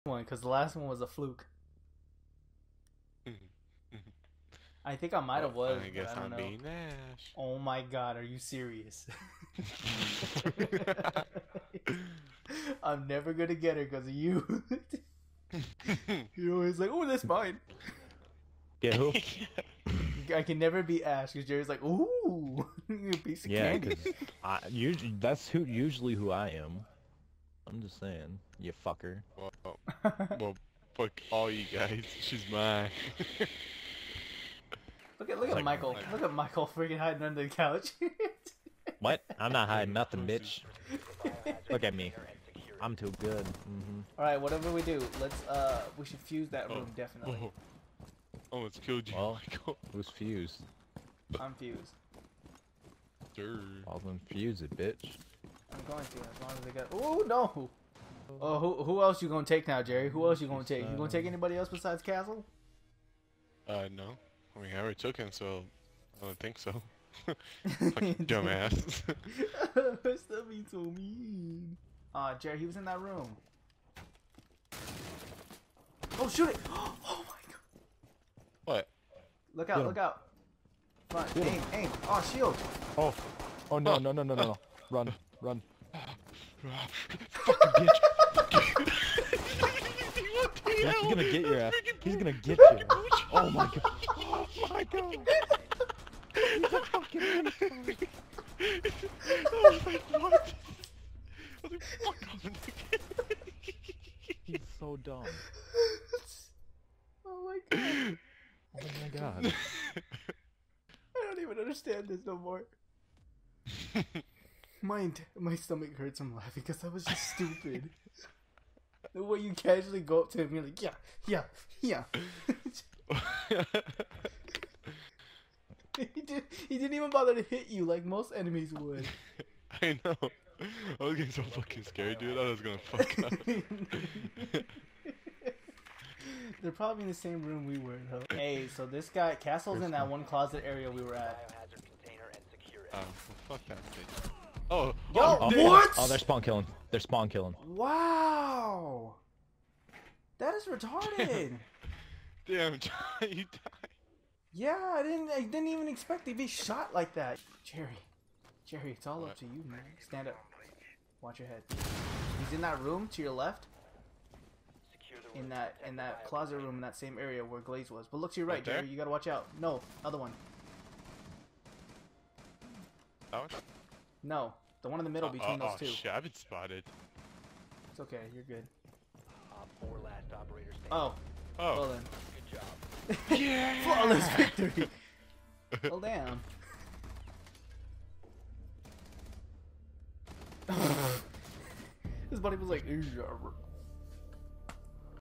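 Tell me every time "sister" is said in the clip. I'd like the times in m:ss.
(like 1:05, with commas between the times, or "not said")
not said.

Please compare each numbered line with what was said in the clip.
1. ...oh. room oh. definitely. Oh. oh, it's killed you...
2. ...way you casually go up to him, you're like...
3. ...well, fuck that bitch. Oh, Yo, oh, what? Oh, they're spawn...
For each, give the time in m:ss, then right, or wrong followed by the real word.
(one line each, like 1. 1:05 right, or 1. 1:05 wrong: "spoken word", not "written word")
1. 0:46 right
2. 1:59 right
3. 2:23 right.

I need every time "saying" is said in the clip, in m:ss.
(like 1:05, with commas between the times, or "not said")
0:28.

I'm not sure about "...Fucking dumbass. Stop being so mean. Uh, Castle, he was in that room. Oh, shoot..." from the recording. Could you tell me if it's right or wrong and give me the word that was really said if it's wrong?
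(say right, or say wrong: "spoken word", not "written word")
wrong: "Jerry", not "Castle".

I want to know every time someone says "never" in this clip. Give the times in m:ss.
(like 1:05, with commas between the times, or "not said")
0:13, 0:20.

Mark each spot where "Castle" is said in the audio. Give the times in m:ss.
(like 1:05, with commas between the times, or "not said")
1:02, 2:19.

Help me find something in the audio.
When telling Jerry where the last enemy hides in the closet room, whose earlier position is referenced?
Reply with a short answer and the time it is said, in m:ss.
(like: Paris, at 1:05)
Glaz, at 2:47.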